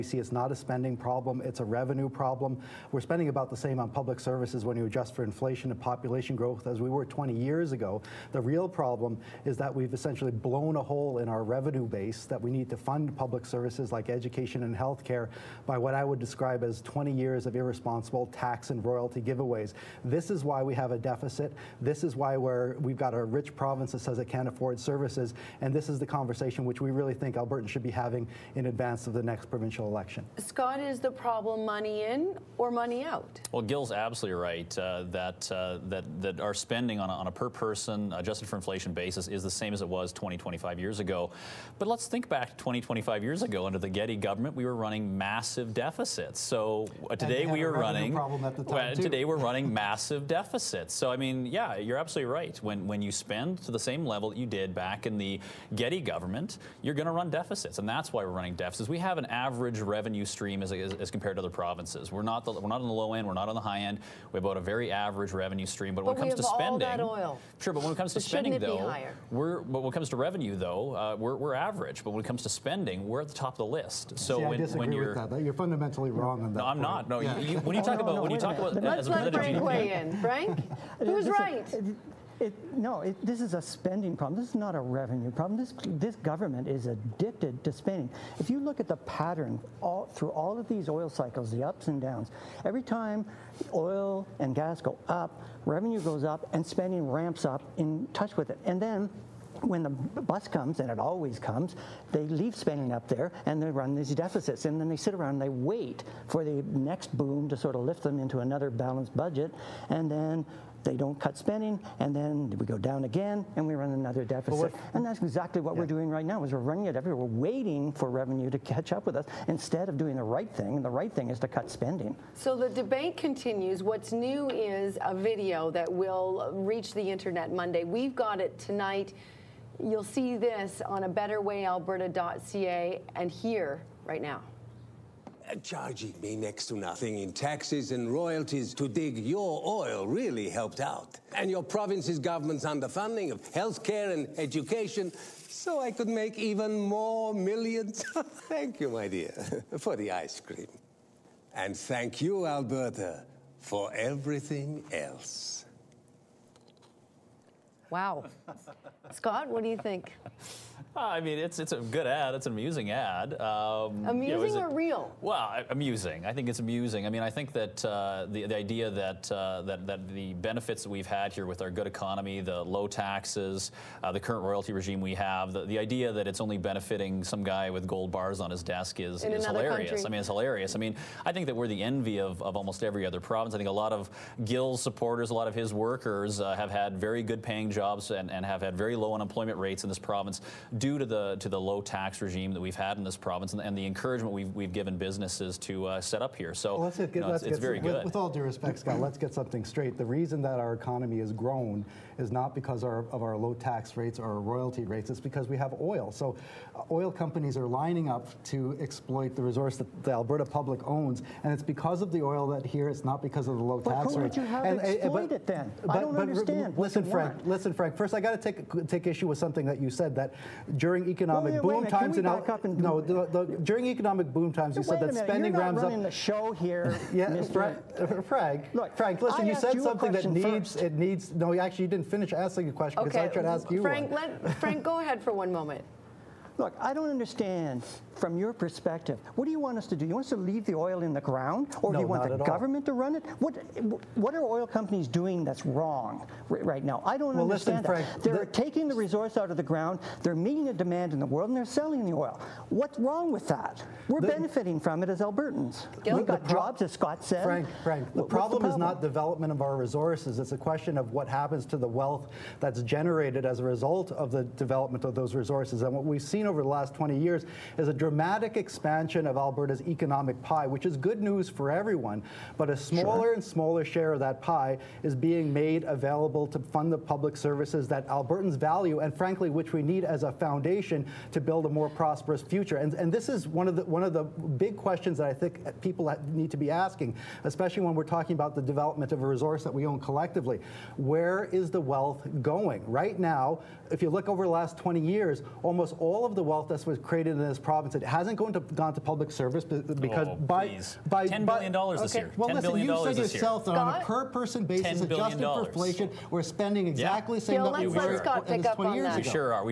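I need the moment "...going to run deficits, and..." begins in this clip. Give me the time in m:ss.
0:56.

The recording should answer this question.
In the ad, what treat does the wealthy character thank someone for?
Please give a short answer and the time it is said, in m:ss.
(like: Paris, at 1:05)
ice cream, at 2:30.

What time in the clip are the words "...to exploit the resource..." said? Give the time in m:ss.
3:28.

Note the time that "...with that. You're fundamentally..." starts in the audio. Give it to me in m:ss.
1:15.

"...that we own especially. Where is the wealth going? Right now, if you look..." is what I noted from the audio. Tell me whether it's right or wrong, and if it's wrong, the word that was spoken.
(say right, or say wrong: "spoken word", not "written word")
wrong: "collectively", not "especially".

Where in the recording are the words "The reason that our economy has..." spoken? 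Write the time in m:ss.
3:19.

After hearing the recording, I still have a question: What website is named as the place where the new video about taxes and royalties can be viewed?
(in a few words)
betterwayalberta.ca.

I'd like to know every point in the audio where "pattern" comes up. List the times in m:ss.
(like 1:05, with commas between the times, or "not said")
1:28.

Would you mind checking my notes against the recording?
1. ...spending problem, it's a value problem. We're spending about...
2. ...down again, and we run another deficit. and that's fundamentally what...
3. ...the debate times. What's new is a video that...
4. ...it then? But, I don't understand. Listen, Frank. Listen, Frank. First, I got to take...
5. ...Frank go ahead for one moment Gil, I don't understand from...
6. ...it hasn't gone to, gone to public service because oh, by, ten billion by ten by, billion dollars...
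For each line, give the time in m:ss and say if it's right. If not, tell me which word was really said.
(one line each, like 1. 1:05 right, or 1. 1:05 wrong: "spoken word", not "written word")
1. 0:00 wrong: "revenue", not "value"
2. 1:52 wrong: "exactly", not "fundamentally"
3. 2:02 wrong: "continues", not "times"
4. 3:35 right
5. 3:54 wrong: "Look", not "Gil"
6. 4:57 right.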